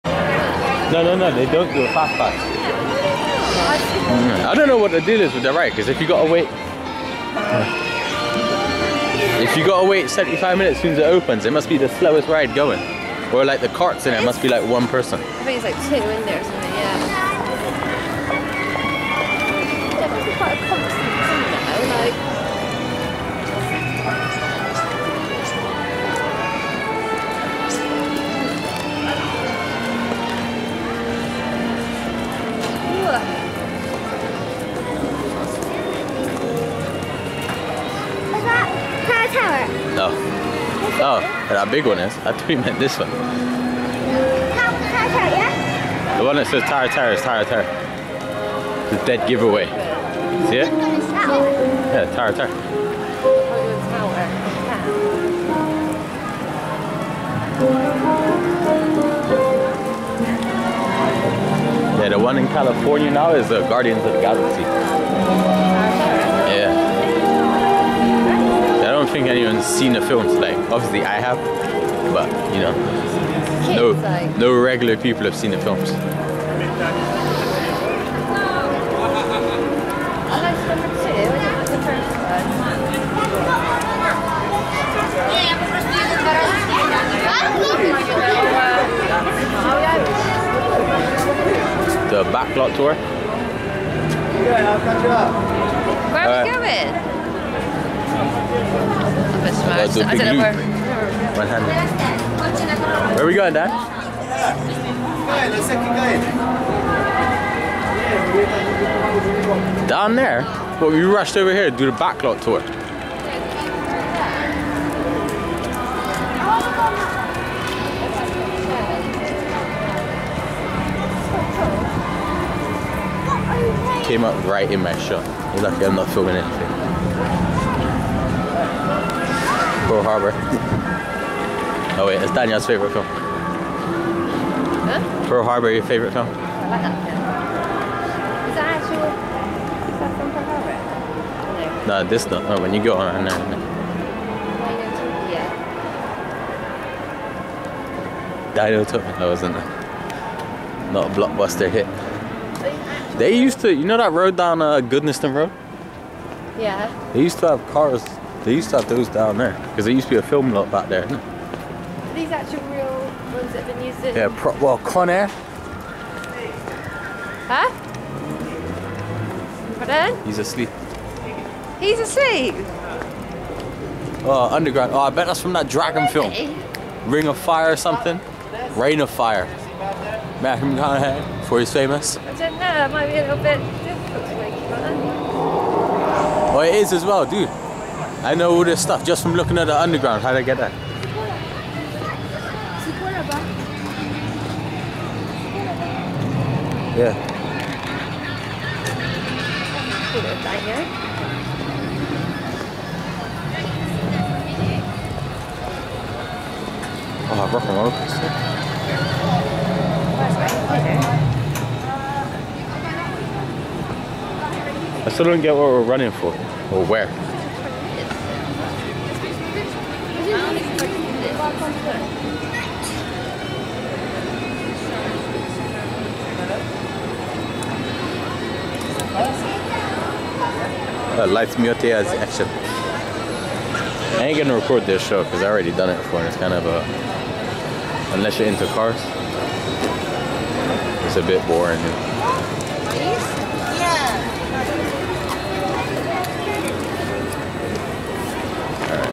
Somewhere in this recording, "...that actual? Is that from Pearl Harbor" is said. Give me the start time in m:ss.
2:18.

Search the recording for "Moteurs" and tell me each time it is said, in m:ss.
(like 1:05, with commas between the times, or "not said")
3:51.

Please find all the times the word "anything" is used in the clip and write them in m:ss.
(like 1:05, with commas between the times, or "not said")
2:06.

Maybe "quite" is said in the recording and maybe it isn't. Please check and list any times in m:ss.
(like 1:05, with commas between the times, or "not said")
0:20.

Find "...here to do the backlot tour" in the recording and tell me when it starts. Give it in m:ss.
1:51.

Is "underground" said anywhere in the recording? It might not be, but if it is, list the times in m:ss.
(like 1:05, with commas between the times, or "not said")
2:54, 3:09.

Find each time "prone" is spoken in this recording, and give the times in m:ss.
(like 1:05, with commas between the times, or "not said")
not said.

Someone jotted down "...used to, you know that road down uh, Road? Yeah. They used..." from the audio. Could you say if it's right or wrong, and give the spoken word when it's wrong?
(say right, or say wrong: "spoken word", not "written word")
right.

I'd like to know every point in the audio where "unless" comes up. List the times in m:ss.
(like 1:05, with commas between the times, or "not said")
3:58.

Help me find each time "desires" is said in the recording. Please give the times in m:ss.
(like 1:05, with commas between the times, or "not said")
not said.